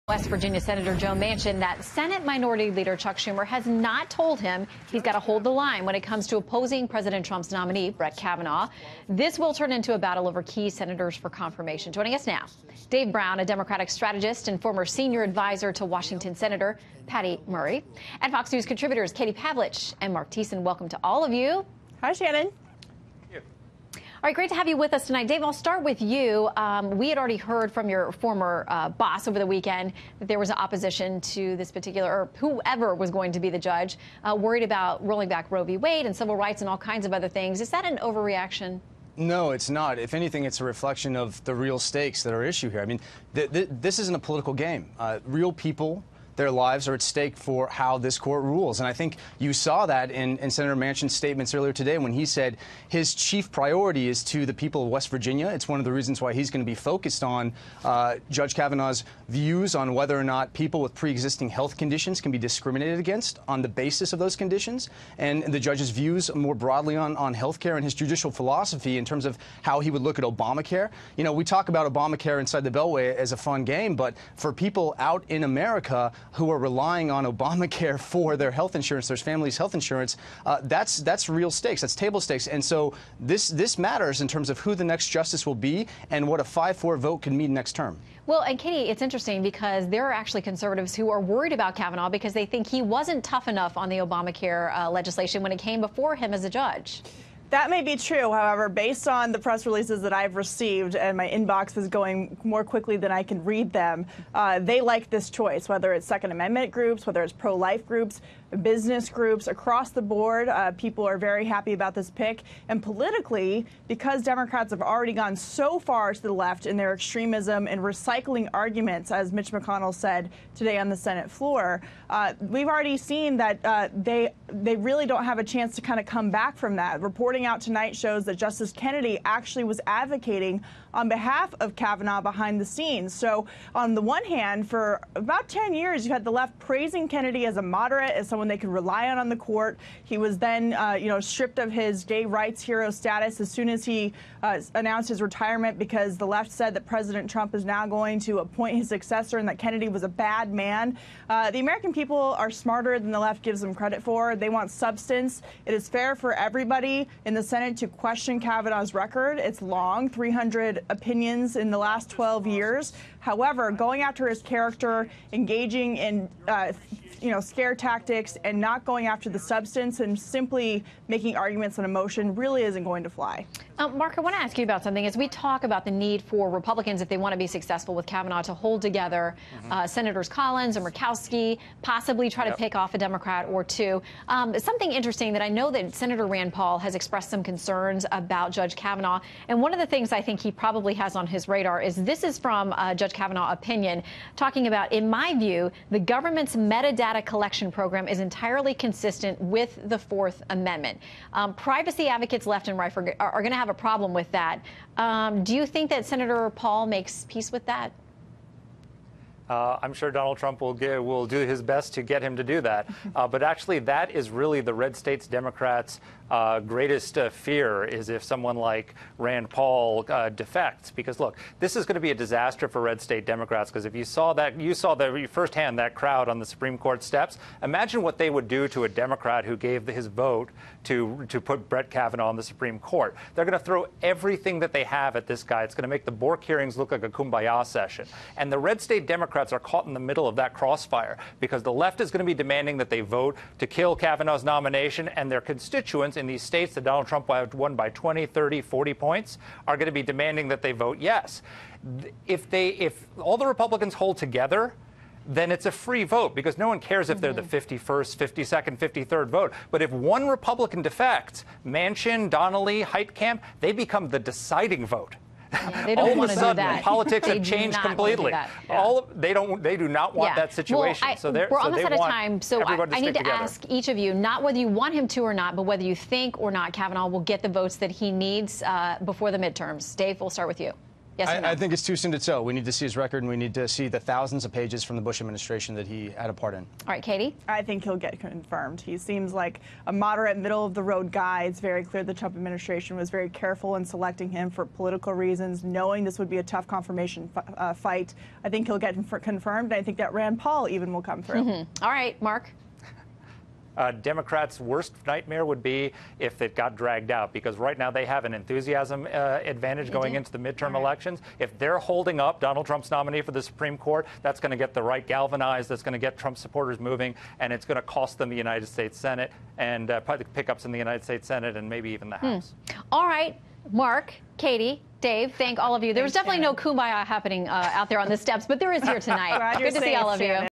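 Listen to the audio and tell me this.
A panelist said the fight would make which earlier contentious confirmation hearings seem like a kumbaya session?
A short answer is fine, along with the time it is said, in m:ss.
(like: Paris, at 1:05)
Bork hearings, at 3:56.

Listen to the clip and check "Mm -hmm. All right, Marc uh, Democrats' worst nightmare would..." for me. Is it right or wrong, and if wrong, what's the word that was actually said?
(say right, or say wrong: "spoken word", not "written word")
right.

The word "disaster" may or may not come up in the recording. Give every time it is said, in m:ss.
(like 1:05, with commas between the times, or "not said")
3:42.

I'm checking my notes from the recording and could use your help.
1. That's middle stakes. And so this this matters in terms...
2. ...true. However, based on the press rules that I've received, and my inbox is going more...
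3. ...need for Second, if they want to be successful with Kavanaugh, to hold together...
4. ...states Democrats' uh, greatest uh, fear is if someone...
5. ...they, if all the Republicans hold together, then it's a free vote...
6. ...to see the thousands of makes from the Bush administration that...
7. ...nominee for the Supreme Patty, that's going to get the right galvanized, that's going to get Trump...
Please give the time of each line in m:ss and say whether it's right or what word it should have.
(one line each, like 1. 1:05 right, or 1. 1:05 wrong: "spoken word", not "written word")
1. 1:21 wrong: "table", not "middle"
2. 1:37 wrong: "releases", not "rules"
3. 2:55 wrong: "Republicans", not "Second"
4. 3:34 right
5. 4:12 right
6. 4:43 wrong: "pages", not "makes"
7. 5:12 wrong: "Court", not "Patty".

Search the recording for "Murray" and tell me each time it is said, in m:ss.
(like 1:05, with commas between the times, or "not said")
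0:17.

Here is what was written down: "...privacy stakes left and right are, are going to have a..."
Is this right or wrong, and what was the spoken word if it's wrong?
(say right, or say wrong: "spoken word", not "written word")
wrong: "advocates", not "stakes".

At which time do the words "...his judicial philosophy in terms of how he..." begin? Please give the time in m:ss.
1:07.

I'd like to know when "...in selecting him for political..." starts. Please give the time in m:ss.
4:53.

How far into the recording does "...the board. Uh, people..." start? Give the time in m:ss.
1:49.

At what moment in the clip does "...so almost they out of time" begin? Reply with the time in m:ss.
4:31.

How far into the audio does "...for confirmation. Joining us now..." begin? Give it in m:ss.
0:11.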